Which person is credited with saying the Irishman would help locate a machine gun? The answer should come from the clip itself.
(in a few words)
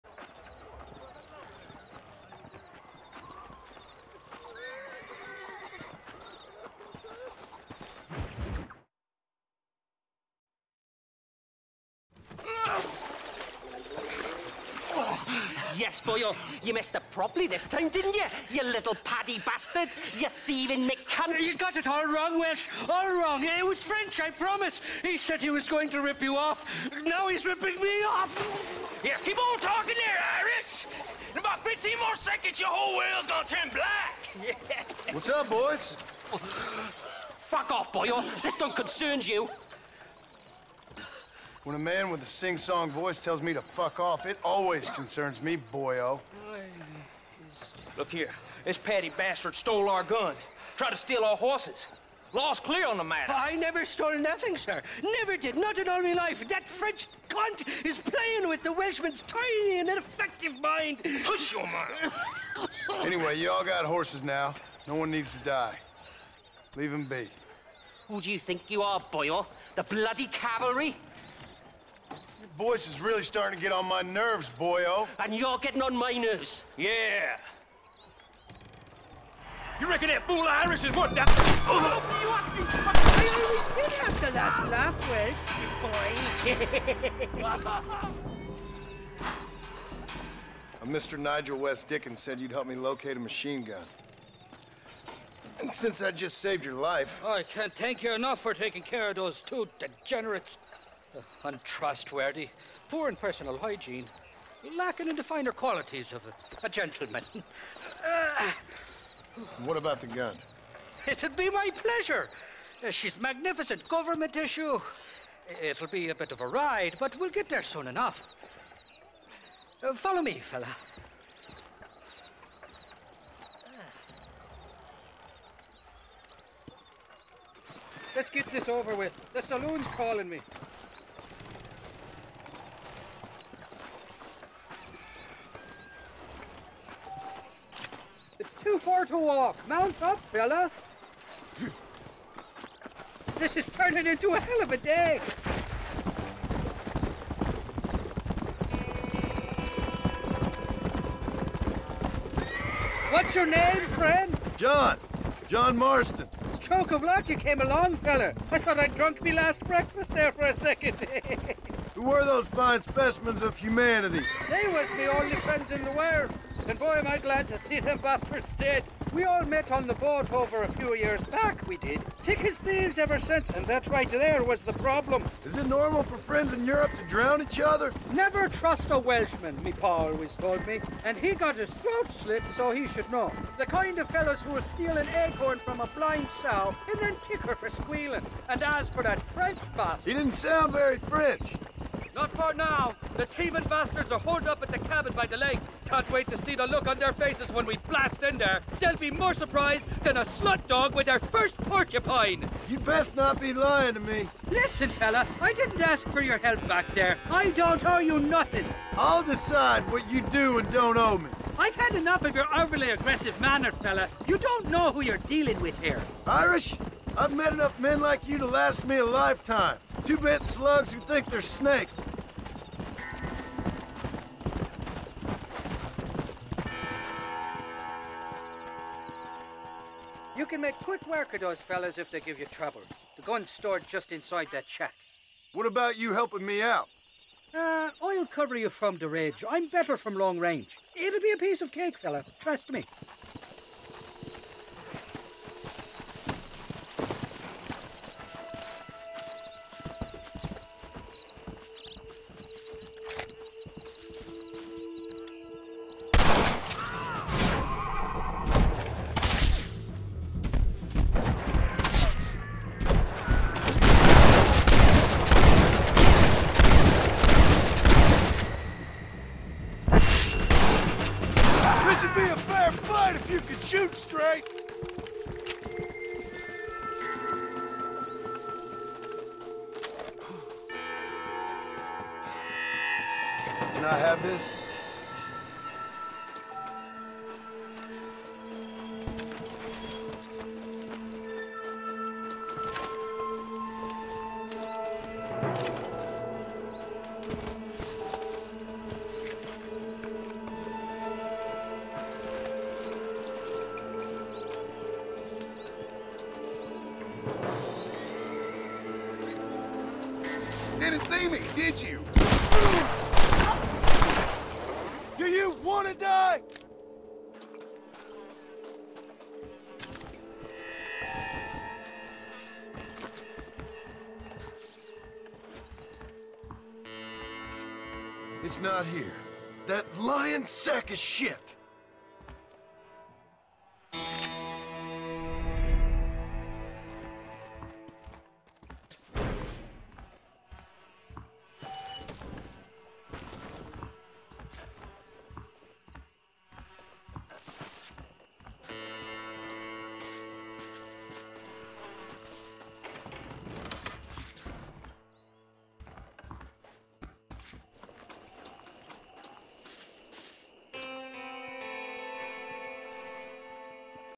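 Nigel West Dickens.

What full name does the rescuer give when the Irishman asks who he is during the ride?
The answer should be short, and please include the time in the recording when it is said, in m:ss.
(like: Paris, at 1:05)
John Marston, at 2:35.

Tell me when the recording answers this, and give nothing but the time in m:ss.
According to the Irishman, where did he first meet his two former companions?
2:49.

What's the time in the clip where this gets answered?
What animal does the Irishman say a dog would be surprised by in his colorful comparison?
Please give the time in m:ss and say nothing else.
3:21.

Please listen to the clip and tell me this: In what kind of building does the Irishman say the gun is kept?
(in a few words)
shack.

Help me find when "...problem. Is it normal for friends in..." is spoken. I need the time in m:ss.
2:54.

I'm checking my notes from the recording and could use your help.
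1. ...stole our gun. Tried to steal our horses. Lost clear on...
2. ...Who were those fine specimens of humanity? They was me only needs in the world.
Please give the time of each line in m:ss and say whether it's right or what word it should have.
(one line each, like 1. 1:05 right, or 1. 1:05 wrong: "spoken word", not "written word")
1. 0:49 right
2. 2:41 wrong: "friends", not "needs".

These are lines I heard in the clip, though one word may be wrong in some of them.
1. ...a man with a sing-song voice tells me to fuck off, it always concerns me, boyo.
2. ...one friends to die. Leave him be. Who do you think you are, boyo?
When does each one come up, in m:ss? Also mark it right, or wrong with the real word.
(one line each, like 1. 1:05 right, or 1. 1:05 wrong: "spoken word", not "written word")
1. 0:41 right
2. 1:04 wrong: "needs", not "friends".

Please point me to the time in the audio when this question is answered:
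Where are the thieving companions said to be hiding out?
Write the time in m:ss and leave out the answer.
3:14.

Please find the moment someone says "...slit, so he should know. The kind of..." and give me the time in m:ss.
3:02.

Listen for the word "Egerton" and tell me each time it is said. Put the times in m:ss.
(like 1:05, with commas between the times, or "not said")
not said.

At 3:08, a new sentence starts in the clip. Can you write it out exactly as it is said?
And as for that French bastard...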